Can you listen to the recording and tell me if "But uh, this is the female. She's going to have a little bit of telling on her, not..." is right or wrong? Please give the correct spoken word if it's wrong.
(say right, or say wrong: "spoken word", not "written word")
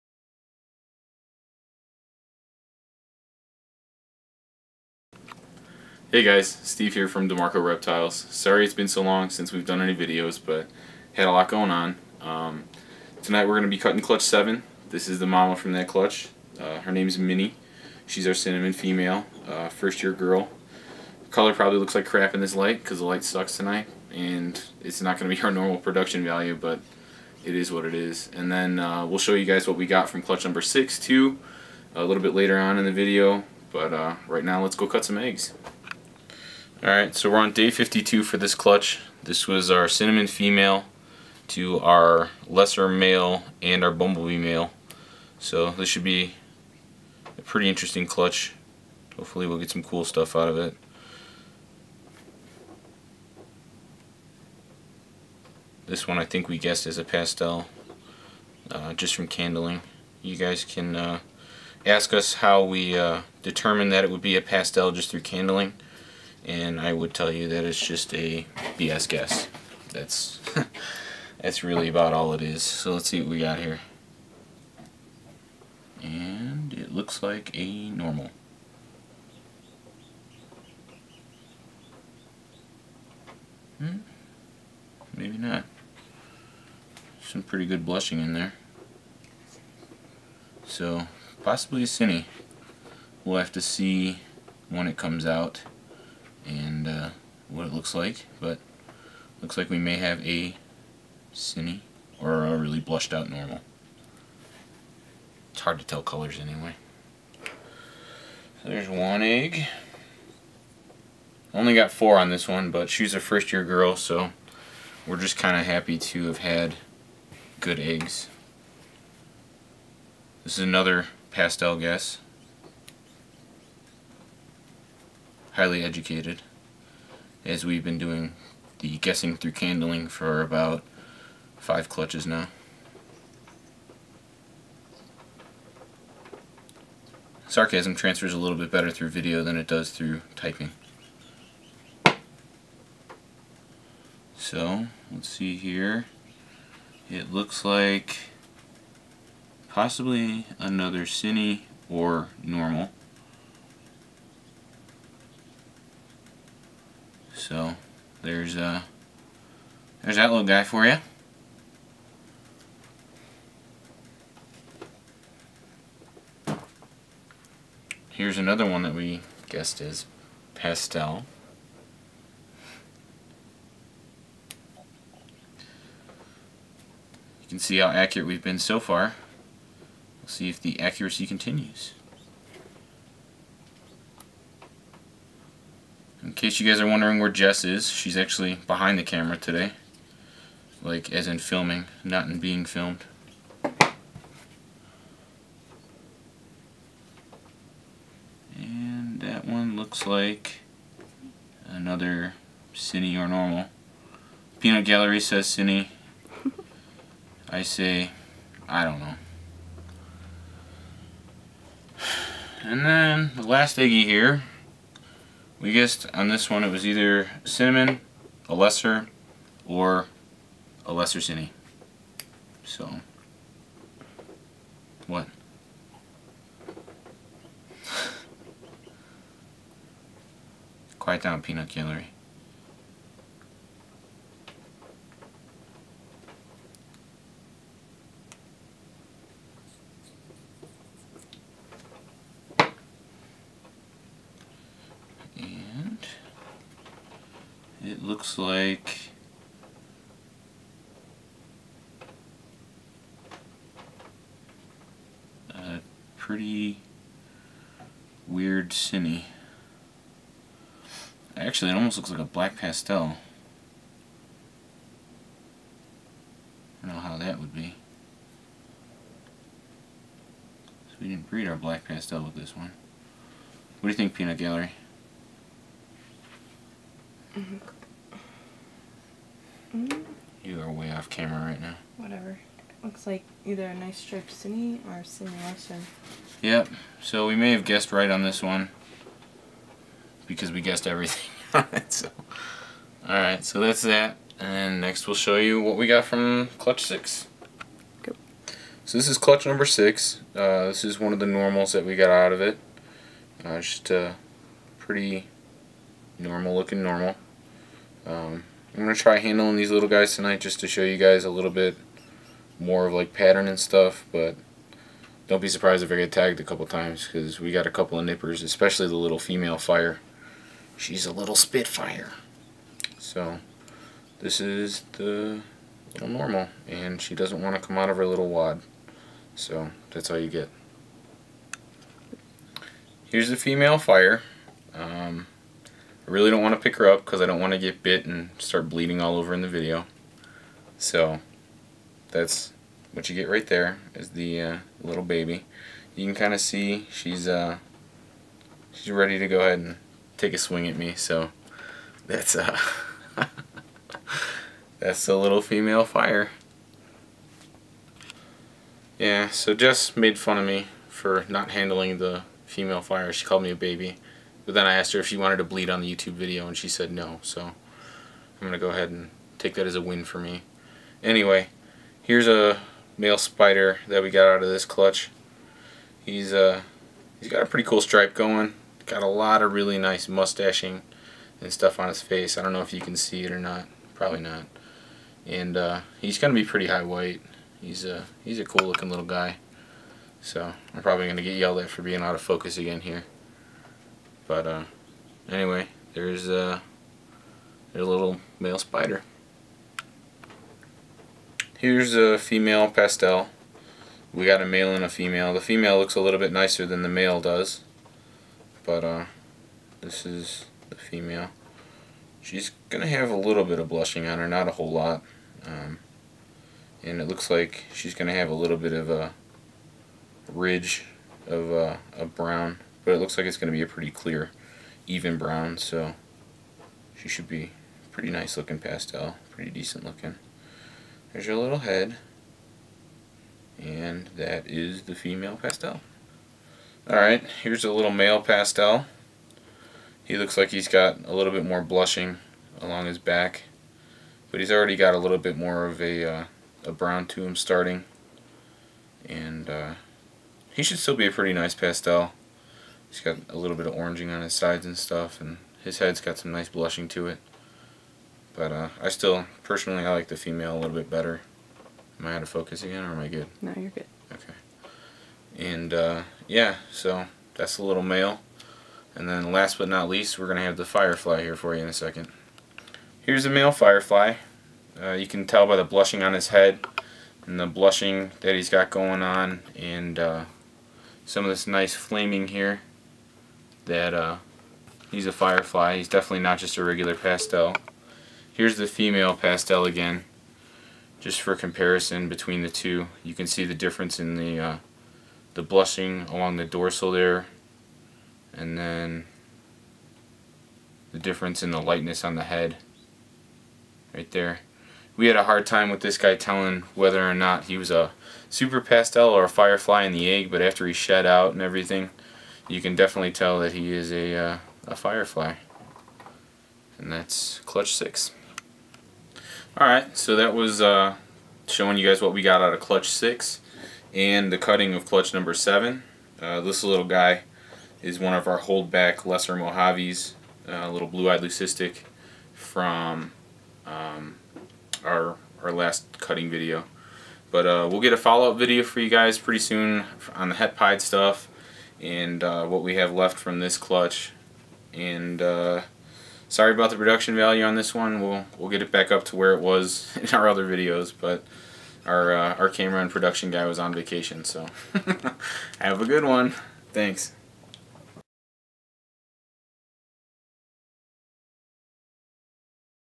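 wrong: "blushing", not "telling".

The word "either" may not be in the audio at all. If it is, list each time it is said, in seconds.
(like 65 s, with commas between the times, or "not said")
216 s, 283 s.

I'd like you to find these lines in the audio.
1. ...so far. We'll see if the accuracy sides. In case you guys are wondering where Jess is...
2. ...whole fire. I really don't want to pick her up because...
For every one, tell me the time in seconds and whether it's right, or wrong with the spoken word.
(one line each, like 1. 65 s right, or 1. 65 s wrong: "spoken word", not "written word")
1. 178 s wrong: "continues", not "sides"
2. 333 s wrong: "female", not "whole".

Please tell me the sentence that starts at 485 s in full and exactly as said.
He's definitely not just a regular pastel.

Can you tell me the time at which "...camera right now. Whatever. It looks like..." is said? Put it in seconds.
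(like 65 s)
281 s.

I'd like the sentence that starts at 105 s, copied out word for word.
It's hard to tell colors anyway.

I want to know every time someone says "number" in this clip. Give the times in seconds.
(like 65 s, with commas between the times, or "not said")
30 s, 299 s, 525 s.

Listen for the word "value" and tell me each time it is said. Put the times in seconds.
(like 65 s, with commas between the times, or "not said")
26 s, 547 s.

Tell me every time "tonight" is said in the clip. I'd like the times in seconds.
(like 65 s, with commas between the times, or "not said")
13 s, 23 s, 310 s.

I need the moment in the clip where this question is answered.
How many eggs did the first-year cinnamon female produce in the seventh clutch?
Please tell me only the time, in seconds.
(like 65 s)
111 s.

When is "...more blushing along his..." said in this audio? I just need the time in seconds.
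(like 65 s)
441 s.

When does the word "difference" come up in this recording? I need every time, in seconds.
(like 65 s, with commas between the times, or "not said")
493 s, 500 s.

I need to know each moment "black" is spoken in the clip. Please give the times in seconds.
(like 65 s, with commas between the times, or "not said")
262 s, 271 s.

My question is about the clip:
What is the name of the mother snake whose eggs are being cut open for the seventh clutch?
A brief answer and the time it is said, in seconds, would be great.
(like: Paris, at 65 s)
Minnie, at 16 s.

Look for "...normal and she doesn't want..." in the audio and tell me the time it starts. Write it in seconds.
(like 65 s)
326 s.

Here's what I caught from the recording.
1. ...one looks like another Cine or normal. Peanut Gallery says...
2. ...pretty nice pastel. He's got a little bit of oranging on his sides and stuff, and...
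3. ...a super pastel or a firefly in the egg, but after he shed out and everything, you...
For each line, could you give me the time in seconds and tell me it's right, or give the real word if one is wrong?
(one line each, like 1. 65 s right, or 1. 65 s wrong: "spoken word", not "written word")
1. 199 s right
2. 451 s right
3. 507 s right.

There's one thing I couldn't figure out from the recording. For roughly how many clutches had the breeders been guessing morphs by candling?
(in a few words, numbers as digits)
5.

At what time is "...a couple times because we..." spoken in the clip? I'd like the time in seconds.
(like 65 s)
316 s.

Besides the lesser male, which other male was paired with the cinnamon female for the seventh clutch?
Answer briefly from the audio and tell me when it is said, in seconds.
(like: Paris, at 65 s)
bumblebee male, at 43 s.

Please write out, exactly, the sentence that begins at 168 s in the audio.
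Here's another one that we guessed is pastel.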